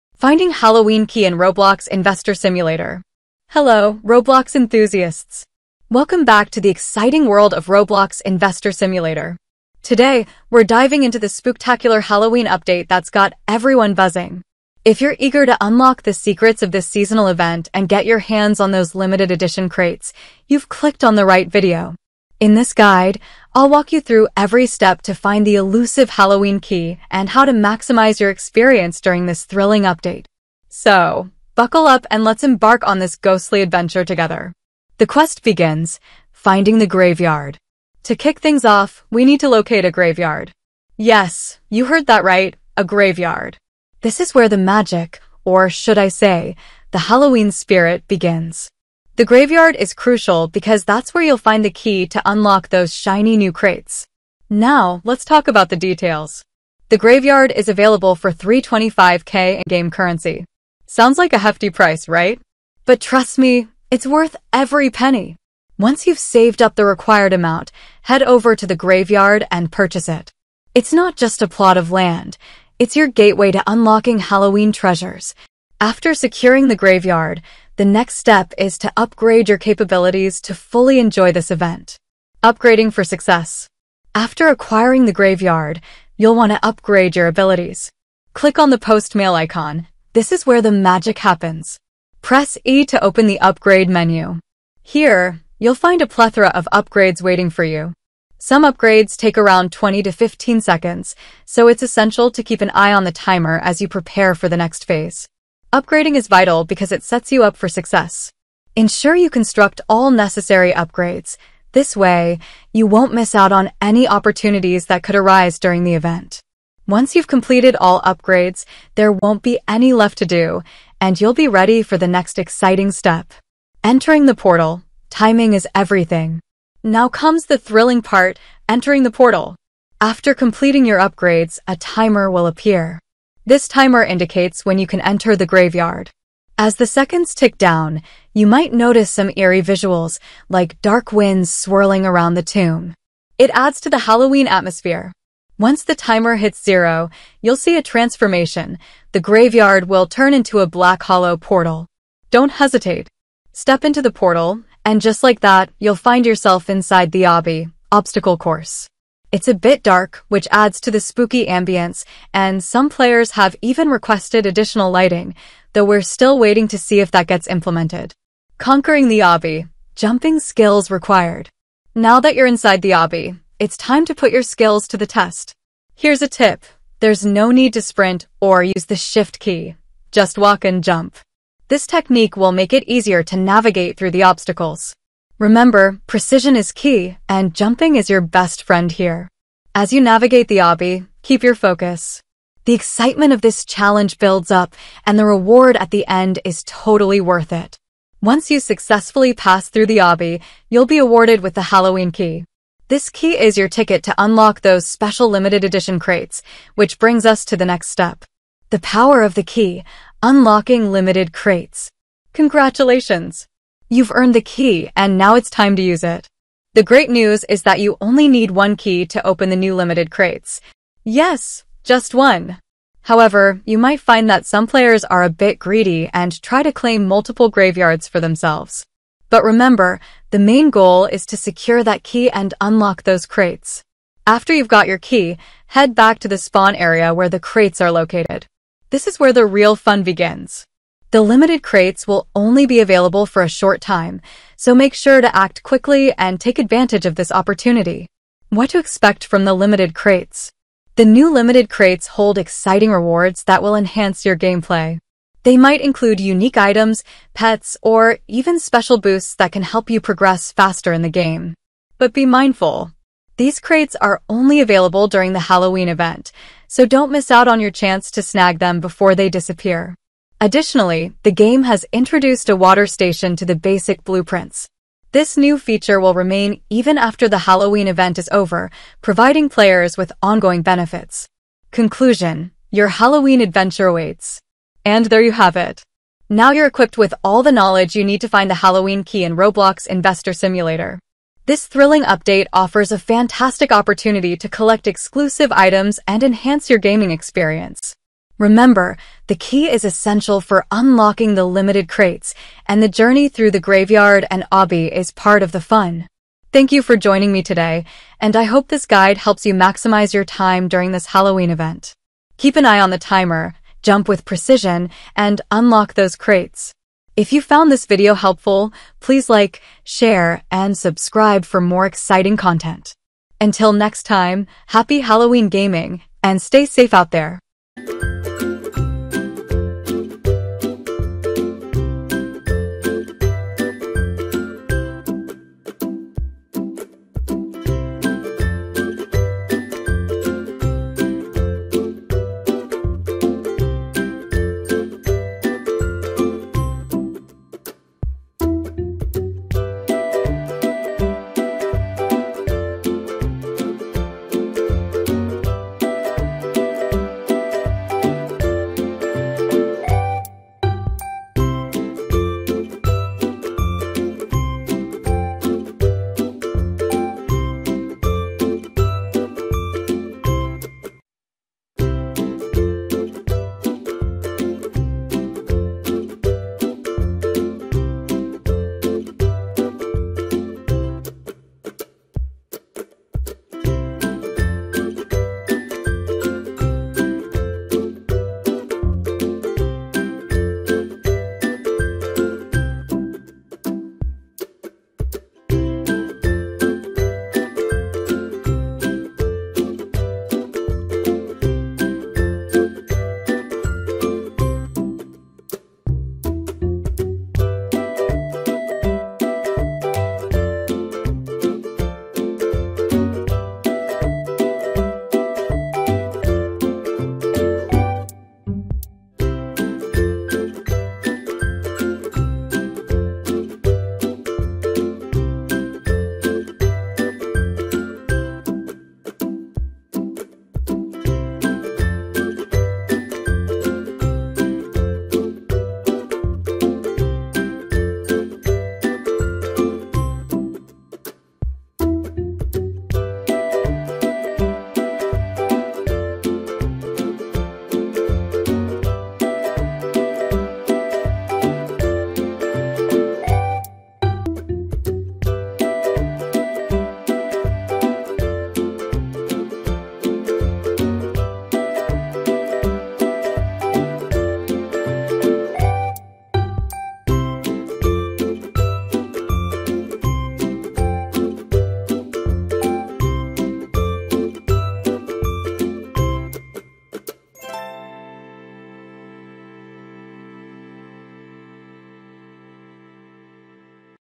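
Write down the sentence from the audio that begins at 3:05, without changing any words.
Remember, precision is key, and jumping is your best friend here.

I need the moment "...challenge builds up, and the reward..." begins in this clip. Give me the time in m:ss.
3:13.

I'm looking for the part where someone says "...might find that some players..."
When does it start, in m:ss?
3:43.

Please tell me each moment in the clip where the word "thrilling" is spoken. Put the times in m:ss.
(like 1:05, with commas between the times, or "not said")
0:29, 2:07, 4:51.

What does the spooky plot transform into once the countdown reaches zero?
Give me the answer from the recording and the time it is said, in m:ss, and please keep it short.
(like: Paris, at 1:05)
black hollow portal, at 2:30.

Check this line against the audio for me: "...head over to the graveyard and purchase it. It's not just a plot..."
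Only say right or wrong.
right.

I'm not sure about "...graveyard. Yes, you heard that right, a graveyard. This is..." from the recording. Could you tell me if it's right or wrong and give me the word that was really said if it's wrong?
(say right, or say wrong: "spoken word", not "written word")
right.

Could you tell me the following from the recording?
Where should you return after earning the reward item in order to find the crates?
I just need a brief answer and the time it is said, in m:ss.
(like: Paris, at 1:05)
spawn area, at 3:56.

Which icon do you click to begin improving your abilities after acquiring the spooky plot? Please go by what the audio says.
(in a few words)
post mail icon.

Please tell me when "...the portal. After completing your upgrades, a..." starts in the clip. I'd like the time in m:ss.
2:09.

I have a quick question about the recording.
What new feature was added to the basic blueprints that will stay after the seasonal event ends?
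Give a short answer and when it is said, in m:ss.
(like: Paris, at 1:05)
water station, at 4:32.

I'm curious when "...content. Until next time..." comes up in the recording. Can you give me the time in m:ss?
5:22.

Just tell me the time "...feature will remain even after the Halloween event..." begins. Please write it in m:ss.
4:35.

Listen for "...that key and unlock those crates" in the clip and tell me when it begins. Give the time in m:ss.
3:51.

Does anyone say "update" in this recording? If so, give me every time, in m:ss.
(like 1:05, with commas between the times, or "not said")
0:12, 0:29, 4:52.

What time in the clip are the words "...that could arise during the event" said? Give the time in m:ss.
1:54.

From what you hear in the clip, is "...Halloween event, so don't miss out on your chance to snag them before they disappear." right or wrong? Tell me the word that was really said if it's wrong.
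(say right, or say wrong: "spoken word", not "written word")
right.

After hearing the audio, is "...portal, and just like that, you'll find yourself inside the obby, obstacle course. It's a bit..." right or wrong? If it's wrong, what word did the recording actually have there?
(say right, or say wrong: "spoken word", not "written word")
right.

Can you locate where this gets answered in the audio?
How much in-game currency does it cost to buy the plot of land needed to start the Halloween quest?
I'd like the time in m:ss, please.
0:58.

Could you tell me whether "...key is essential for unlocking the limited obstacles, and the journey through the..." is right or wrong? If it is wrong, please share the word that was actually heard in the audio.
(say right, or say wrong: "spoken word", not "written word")
wrong: "crates", not "obstacles".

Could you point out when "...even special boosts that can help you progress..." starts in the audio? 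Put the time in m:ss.
4:18.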